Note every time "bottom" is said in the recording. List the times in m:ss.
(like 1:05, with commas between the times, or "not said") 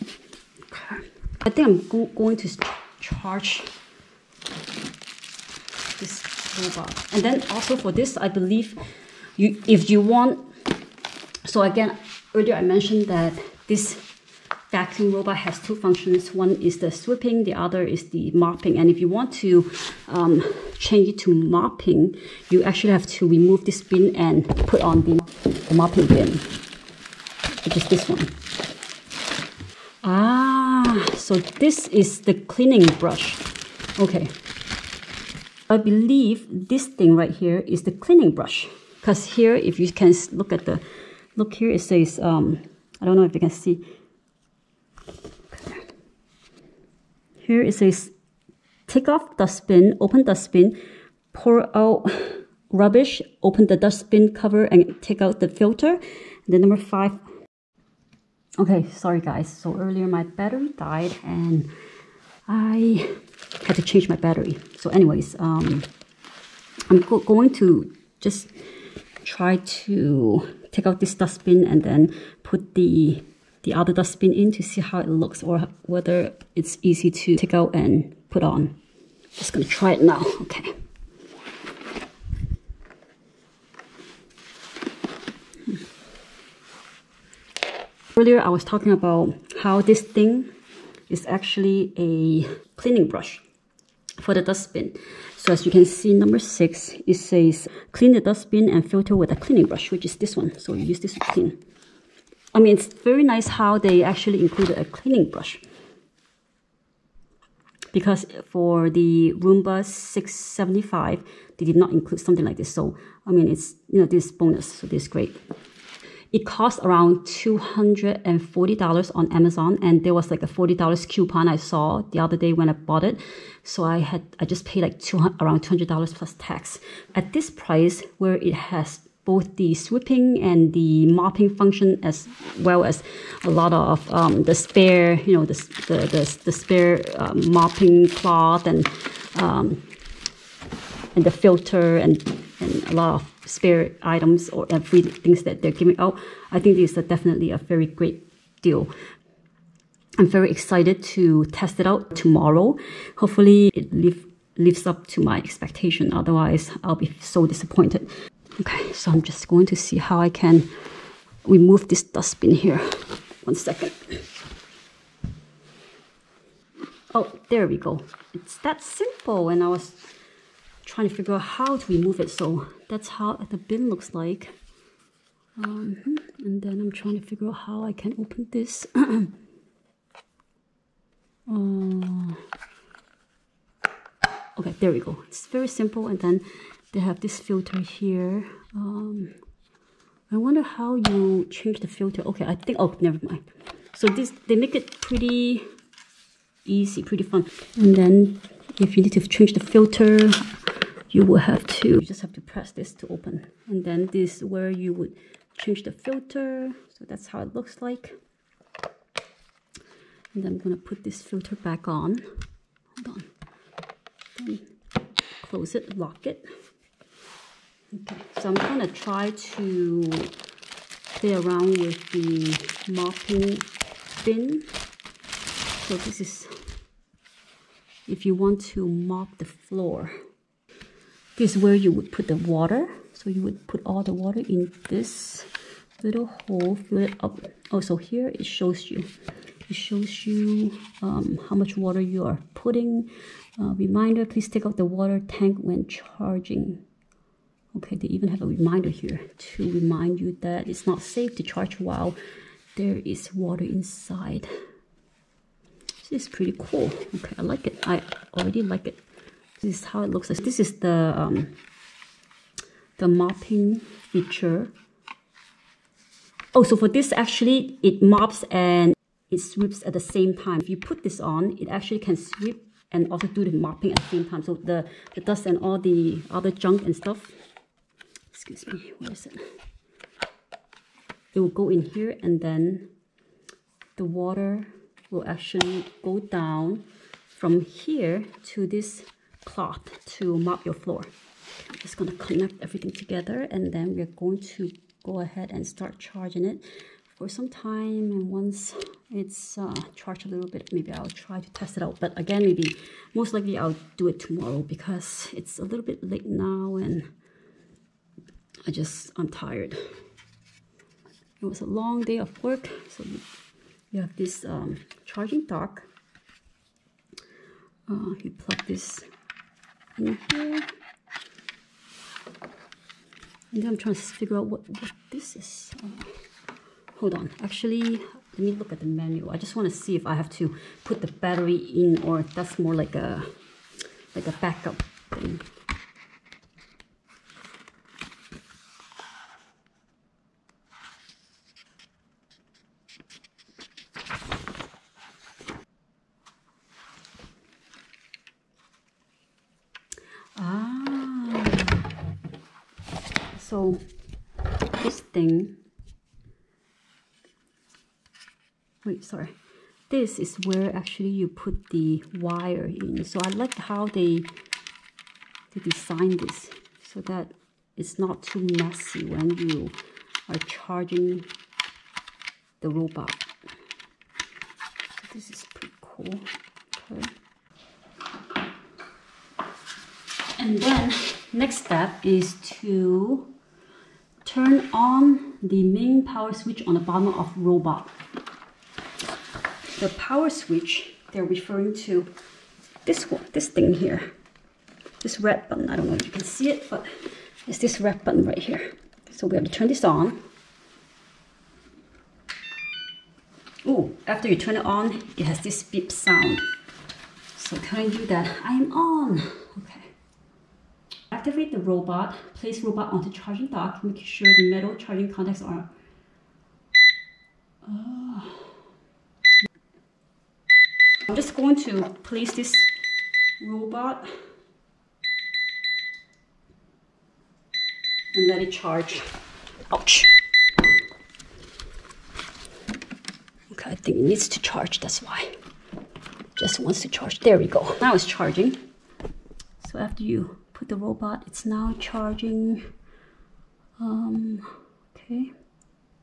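6:26.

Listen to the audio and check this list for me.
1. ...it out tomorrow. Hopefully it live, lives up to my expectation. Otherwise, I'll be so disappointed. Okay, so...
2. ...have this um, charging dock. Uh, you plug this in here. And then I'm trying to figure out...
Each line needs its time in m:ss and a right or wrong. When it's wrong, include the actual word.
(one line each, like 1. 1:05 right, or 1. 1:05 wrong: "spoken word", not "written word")
1. 2:31 right
2. 5:14 right.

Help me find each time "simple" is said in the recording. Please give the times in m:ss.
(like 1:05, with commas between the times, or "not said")
2:48, 3:05.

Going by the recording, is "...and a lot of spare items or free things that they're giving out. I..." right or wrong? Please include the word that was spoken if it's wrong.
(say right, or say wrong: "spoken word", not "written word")
right.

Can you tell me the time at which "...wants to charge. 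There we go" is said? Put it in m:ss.
7:16.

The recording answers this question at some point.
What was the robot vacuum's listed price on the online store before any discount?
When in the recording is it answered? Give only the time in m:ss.
1:57.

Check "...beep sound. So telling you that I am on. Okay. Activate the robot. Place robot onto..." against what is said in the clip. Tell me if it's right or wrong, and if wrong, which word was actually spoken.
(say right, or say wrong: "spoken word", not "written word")
right.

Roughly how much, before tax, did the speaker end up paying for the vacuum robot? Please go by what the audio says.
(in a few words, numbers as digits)
$200.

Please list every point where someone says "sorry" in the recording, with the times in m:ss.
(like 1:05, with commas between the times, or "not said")
0:59, 5:59.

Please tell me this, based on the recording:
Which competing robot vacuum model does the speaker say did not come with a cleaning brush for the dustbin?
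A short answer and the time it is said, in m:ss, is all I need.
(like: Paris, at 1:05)
Roomba 675, at 1:49.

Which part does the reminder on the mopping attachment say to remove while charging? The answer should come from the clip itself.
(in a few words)
water tank.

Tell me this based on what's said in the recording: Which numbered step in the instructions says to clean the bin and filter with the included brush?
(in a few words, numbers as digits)
6.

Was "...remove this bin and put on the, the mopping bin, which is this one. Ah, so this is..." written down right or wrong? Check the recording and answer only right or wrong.
right.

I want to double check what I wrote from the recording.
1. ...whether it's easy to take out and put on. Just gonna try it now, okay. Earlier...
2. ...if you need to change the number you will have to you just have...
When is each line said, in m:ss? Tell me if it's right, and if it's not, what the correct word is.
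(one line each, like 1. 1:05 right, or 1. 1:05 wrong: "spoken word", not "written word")
1. 1:15 right
2. 3:18 wrong: "filter", not "number".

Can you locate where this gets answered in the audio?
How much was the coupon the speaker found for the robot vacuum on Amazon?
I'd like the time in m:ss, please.
2:00.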